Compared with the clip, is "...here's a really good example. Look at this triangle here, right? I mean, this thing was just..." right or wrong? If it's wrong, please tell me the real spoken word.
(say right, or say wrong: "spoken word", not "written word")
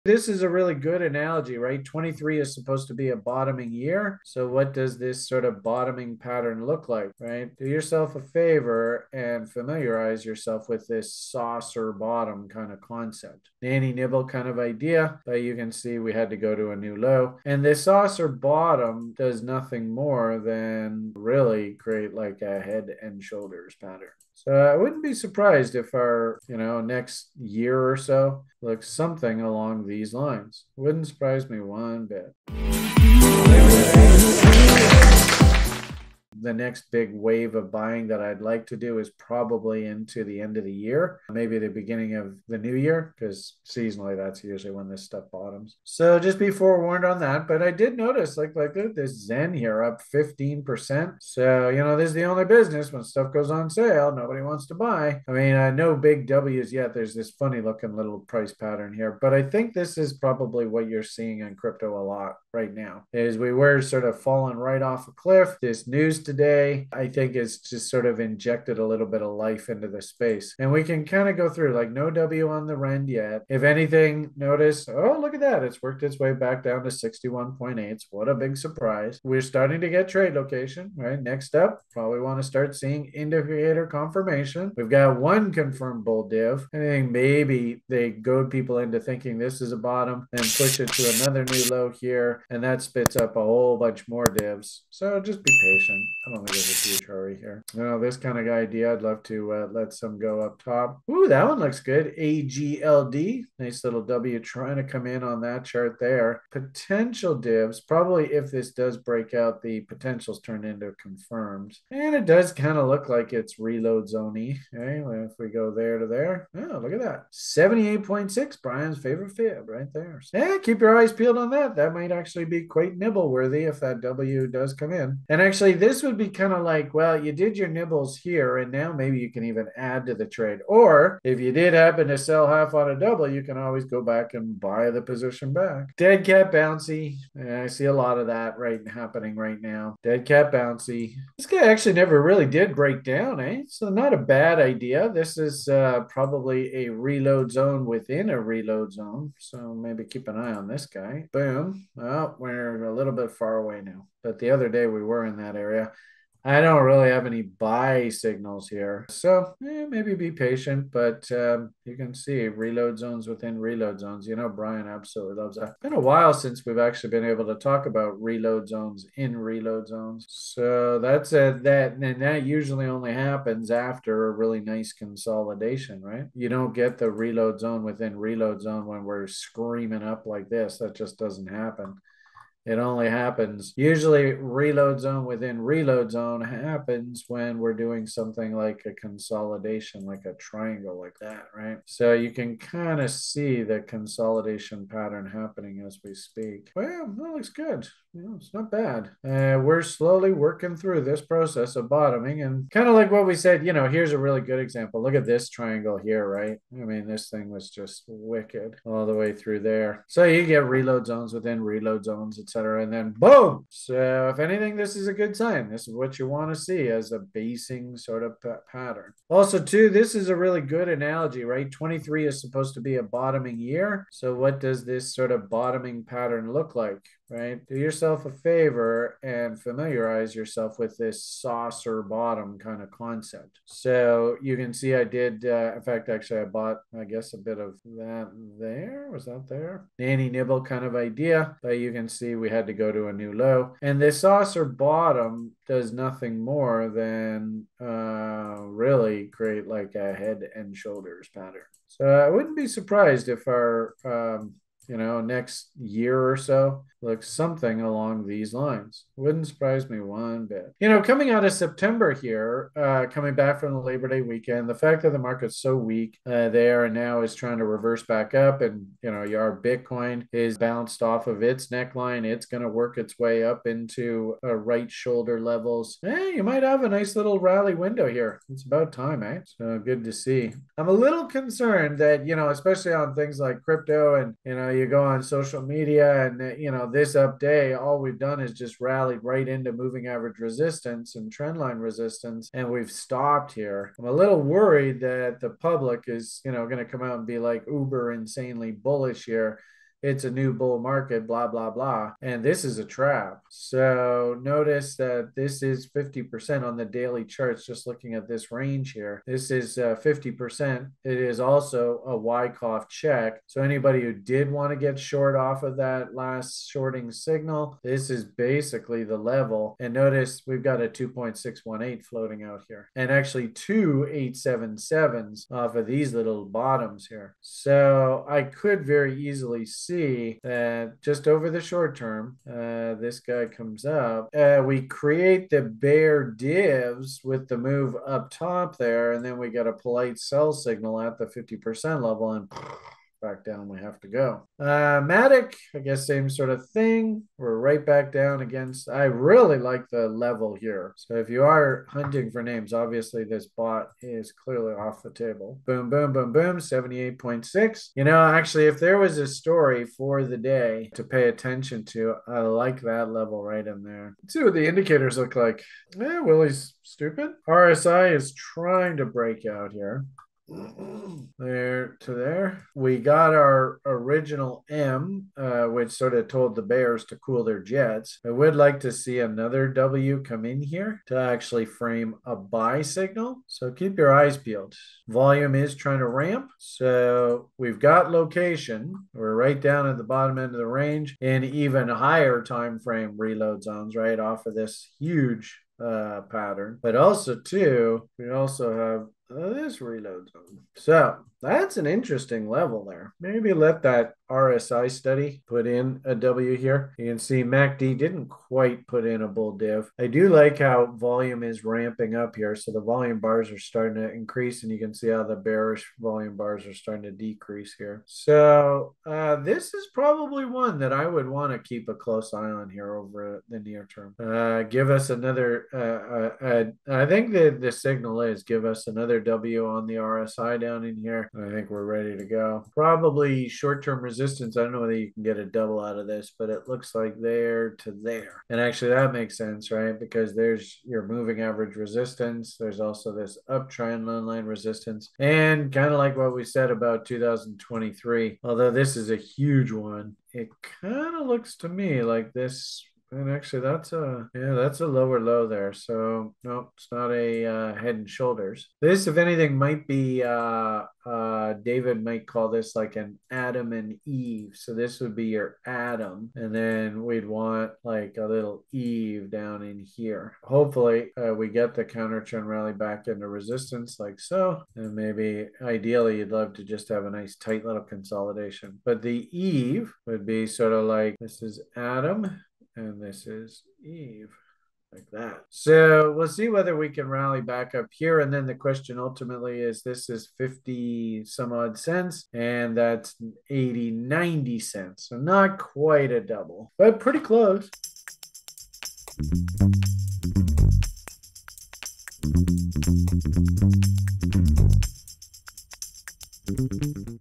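right.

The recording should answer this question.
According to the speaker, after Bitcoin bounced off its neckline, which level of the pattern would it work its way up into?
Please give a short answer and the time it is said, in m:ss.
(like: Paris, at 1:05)
right shoulder levels, at 4:34.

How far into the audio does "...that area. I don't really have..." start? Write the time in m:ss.
2:35.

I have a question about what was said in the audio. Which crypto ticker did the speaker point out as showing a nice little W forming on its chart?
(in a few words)
AGLD.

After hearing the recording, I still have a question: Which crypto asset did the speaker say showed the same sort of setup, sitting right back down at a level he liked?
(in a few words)
Matic.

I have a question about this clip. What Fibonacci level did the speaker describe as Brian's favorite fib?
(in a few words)
78.6.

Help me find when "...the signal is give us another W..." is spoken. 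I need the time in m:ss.
7:07.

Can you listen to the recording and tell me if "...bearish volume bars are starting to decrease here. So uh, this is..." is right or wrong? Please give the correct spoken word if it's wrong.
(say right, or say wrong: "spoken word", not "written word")
right.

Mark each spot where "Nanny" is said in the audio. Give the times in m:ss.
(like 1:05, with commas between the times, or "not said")
0:13, 3:59.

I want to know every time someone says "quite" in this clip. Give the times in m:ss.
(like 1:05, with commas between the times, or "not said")
2:02, 6:48, 8:15.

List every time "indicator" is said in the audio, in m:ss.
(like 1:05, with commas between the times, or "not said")
1:23, 6:04.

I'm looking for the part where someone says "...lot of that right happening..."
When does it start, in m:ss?
2:17.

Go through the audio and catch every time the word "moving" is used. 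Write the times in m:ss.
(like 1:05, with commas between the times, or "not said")
4:49, 7:21.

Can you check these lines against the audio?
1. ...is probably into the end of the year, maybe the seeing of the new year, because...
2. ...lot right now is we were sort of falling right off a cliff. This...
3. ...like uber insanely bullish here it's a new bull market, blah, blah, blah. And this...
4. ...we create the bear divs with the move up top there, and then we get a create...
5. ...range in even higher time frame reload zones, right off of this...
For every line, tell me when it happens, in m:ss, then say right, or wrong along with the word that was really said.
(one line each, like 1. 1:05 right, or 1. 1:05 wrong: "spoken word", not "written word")
1. 0:38 wrong: "beginning", not "seeing"
2. 1:02 right
3. 4:57 right
4. 5:34 wrong: "polite", not "create"
5. 6:30 right.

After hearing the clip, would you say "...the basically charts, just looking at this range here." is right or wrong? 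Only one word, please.
wrong.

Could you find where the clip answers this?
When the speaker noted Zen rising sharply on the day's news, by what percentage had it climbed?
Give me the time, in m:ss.
0:50.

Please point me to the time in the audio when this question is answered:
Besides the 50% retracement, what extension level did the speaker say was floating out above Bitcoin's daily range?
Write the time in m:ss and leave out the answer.
5:20.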